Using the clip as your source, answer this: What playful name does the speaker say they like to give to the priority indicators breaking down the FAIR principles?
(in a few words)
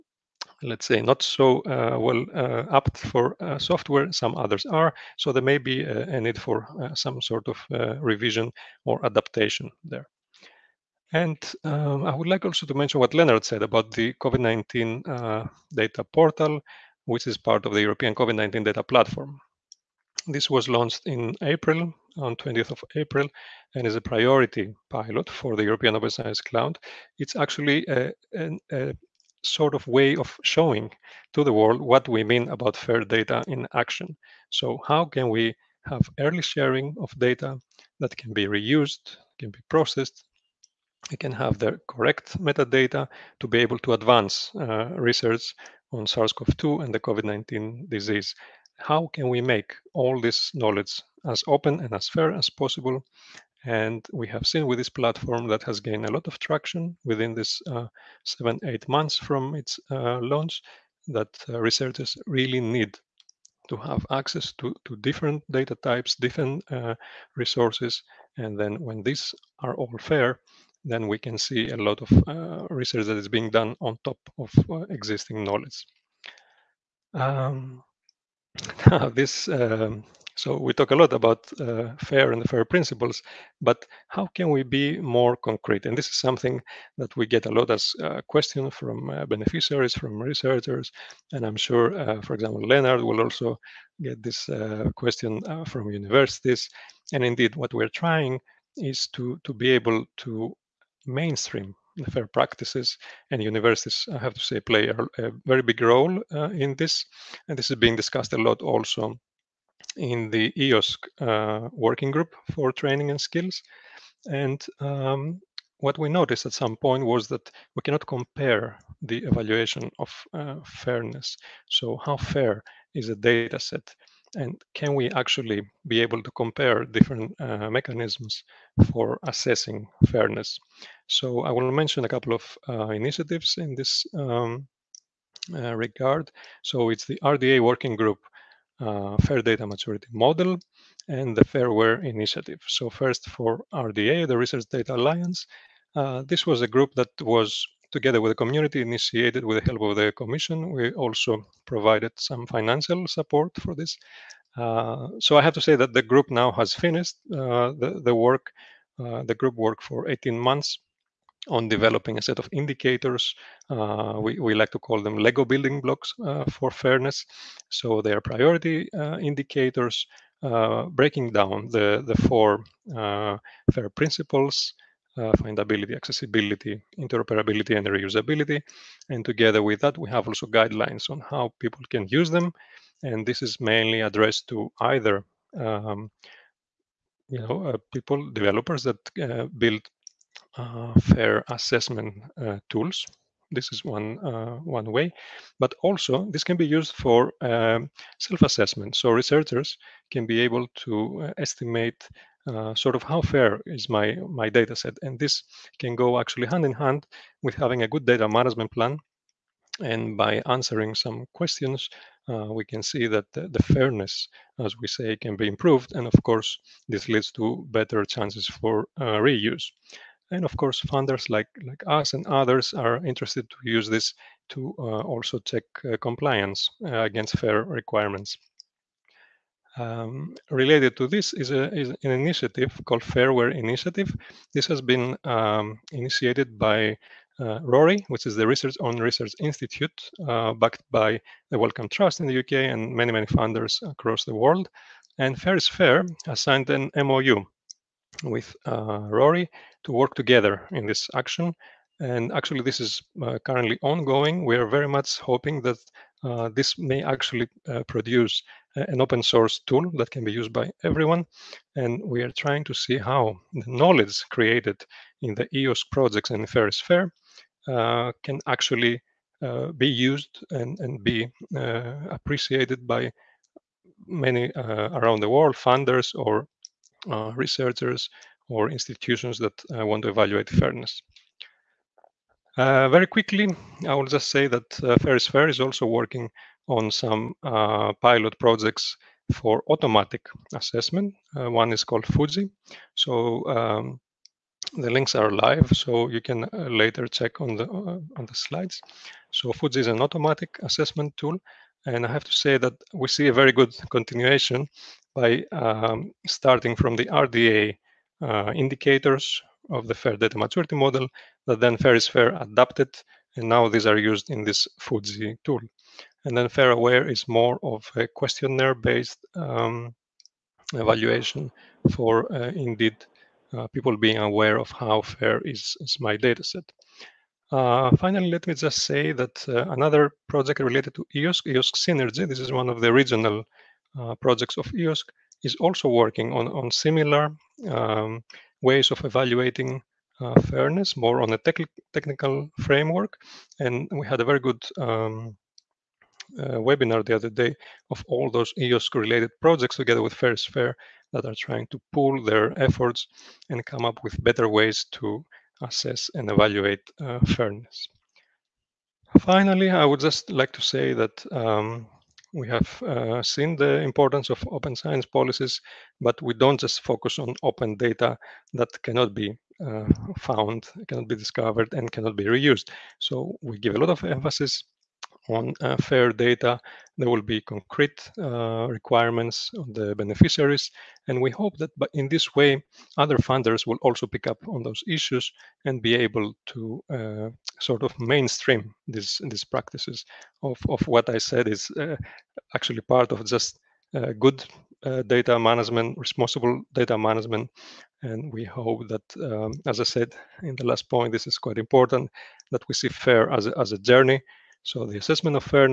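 Lego building blocks.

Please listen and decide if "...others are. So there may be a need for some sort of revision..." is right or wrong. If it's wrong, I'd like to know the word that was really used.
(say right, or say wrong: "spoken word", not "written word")
right.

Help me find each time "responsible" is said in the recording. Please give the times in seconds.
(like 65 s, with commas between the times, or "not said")
395 s.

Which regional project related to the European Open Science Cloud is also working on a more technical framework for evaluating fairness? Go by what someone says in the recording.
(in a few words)
EOSC Synergy.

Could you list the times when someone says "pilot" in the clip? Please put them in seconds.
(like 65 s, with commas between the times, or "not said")
24 s, 288 s.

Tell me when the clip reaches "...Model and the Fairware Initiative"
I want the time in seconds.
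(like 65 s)
140 s.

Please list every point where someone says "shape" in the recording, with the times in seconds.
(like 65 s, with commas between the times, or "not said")
not said.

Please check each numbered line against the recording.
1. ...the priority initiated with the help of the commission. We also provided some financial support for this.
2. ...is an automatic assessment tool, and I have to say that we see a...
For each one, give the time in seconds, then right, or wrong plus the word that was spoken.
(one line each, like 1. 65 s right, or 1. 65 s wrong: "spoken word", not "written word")
1. 148 s wrong: "community", not "priority"
2. 299 s right.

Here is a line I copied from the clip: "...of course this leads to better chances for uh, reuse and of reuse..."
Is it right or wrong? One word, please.
wrong.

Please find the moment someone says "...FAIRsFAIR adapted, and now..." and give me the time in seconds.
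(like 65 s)
311 s.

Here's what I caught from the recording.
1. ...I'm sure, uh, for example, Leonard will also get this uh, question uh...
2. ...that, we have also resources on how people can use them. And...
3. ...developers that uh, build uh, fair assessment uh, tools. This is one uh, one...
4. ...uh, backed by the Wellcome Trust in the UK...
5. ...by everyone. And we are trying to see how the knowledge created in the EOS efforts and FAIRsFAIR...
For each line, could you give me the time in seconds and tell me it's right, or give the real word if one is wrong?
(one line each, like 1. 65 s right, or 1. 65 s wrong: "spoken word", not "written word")
1. 91 s right
2. 179 s wrong: "guidelines", not "resources"
3. 188 s right
4. 240 s right
5. 260 s wrong: "projects", not "efforts".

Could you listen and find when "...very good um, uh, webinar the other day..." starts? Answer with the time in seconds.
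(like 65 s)
344 s.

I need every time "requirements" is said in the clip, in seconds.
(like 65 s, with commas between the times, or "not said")
227 s, 378 s.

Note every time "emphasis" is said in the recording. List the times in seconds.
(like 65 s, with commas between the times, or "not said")
374 s.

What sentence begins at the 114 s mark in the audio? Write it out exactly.
And um, what we noticed at some point was that we cannot compare the evaluation of uh, fairness.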